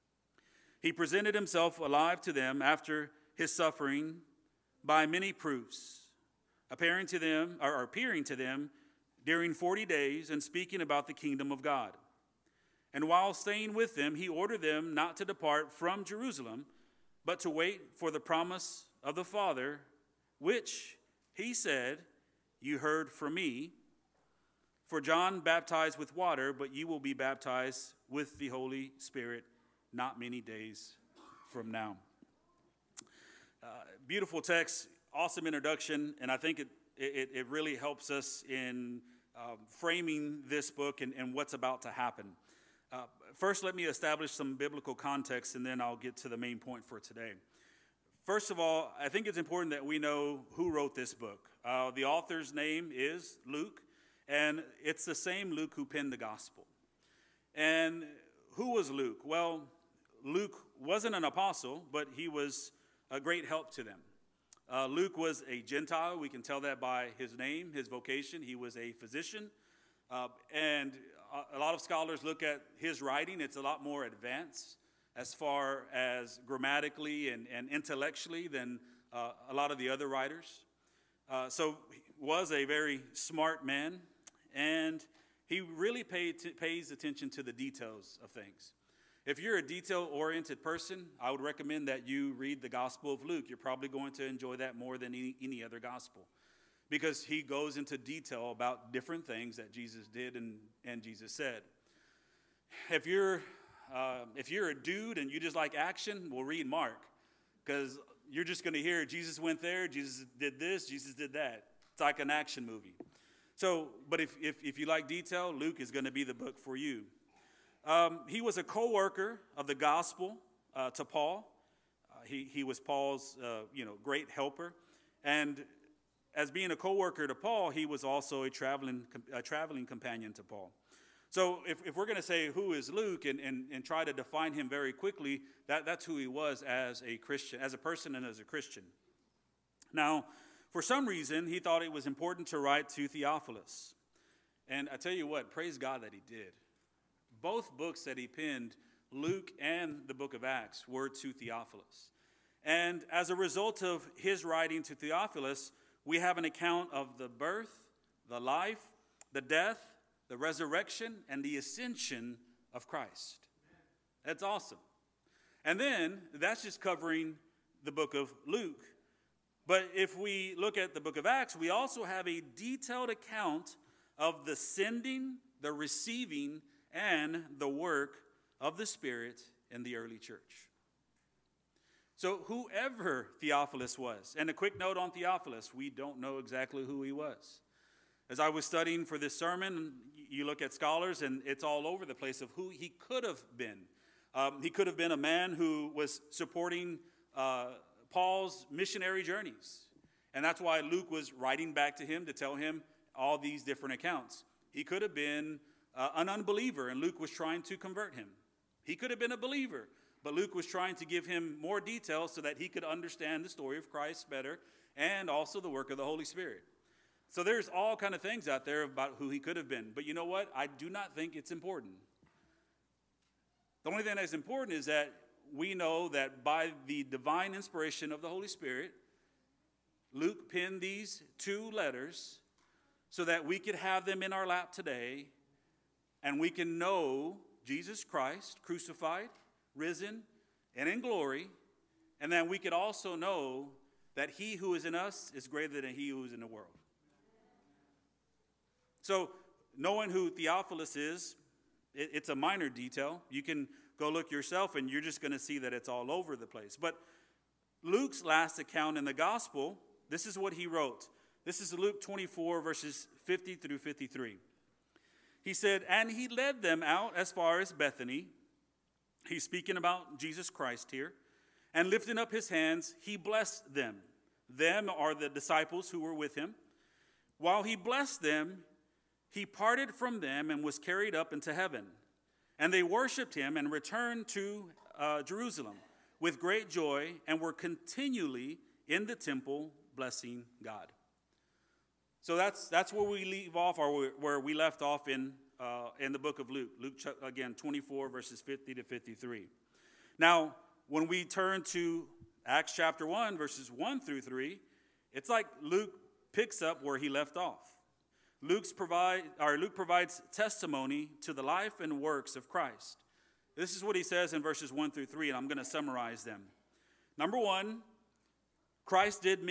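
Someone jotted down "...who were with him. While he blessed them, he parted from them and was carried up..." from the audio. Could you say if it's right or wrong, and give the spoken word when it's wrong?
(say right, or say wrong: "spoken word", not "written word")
right.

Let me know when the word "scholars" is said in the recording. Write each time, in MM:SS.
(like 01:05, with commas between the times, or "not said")
01:11, 03:10.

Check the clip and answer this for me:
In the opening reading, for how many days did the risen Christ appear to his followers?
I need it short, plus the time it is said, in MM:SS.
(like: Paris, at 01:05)
40, at 00:09.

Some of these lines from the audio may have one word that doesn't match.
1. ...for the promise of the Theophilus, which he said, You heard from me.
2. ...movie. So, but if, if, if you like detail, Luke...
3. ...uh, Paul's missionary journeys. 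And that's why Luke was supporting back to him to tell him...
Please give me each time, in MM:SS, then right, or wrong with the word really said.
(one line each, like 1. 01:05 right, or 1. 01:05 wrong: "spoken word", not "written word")
1. 00:17 wrong: "Father", not "Theophilus"
2. 01:52 right
3. 03:17 wrong: "writing", not "supporting".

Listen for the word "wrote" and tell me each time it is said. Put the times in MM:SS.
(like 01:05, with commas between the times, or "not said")
00:50, 04:20.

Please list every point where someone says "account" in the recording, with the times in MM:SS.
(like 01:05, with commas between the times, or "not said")
02:36, 02:53, 03:23, 04:18.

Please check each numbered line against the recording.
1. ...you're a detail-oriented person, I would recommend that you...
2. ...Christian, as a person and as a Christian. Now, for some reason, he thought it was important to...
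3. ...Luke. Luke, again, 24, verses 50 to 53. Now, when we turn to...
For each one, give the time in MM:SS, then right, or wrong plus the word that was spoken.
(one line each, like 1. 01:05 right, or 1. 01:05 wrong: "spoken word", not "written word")
1. 01:29 right
2. 02:17 right
3. 04:56 right.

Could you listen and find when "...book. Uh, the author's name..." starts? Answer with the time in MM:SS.
00:51.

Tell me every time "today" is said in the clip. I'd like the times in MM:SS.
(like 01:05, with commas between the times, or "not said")
00:46, 03:54.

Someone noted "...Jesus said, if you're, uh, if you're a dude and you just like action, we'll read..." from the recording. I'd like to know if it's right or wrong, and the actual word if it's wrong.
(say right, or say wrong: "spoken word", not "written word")
right.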